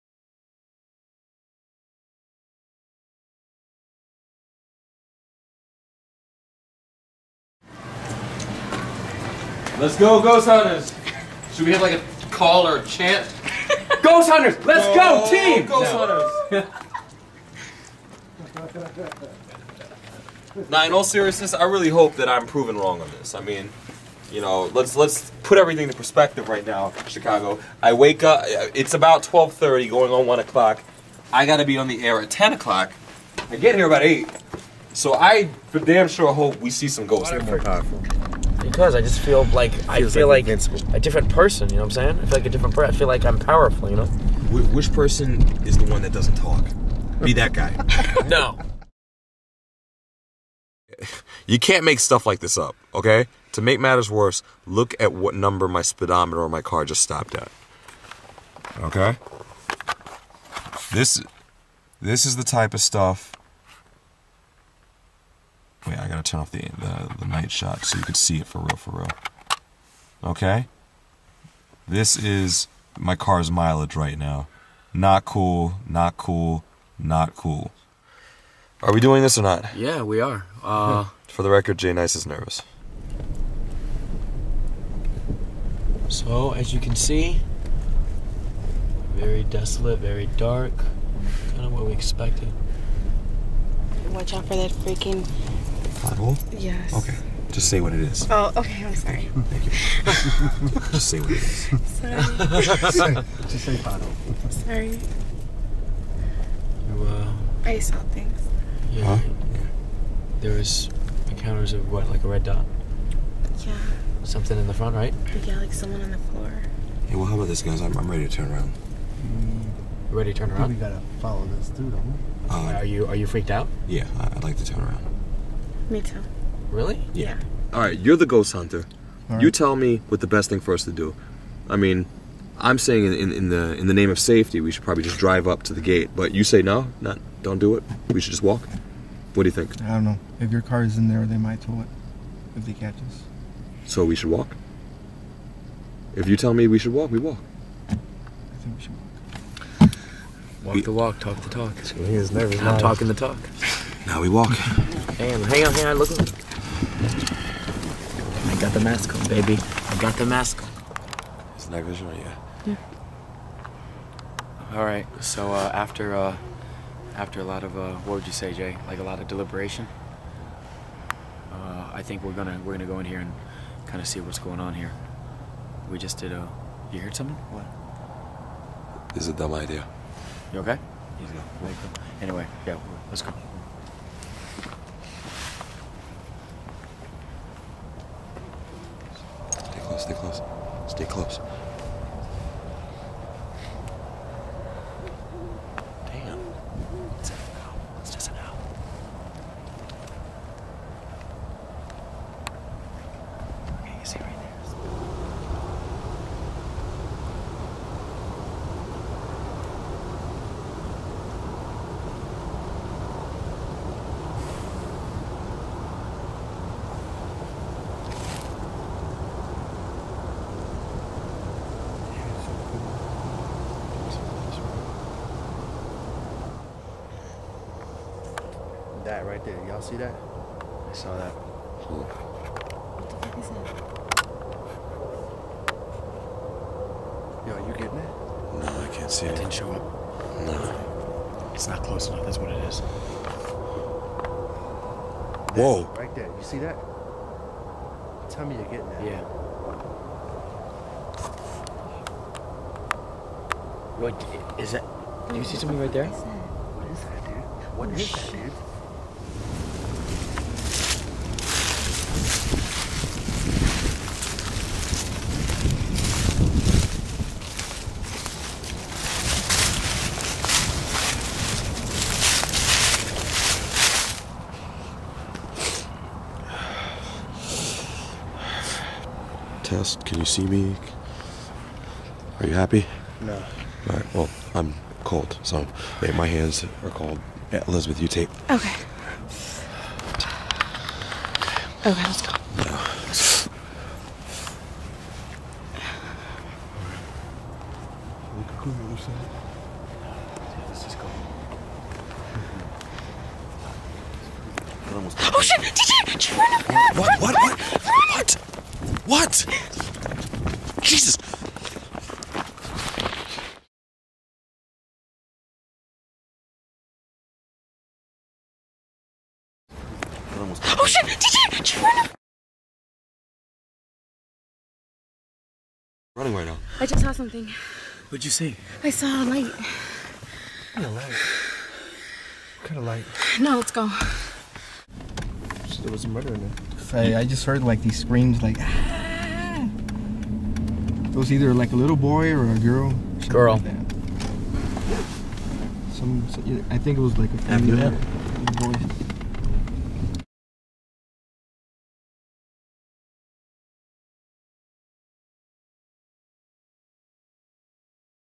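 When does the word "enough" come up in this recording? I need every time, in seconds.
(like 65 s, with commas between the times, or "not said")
242 s.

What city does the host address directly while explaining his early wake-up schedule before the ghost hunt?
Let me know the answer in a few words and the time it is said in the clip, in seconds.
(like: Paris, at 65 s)
Chicago, at 27 s.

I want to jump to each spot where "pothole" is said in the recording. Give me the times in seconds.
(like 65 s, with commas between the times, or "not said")
96 s, 103 s.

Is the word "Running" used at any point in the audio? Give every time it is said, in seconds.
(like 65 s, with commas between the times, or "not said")
326 s.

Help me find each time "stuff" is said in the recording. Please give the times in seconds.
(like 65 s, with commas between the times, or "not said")
51 s, 62 s.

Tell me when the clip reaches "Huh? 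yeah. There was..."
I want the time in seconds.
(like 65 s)
109 s.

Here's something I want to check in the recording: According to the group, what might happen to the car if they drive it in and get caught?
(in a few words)
Tow it.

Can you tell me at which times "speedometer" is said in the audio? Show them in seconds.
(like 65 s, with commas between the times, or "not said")
55 s.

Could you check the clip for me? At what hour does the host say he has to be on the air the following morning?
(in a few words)
10 o'clock.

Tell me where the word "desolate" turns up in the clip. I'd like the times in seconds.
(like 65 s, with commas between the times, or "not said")
89 s.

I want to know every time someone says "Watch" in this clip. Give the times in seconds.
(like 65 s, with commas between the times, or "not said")
94 s.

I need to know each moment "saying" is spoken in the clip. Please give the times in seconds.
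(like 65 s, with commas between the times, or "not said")
42 s, 132 s.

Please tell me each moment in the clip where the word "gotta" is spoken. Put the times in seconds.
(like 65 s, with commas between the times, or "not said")
31 s, 66 s, 120 s.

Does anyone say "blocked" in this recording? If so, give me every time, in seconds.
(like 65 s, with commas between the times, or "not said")
not said.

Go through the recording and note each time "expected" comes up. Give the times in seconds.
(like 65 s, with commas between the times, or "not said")
91 s.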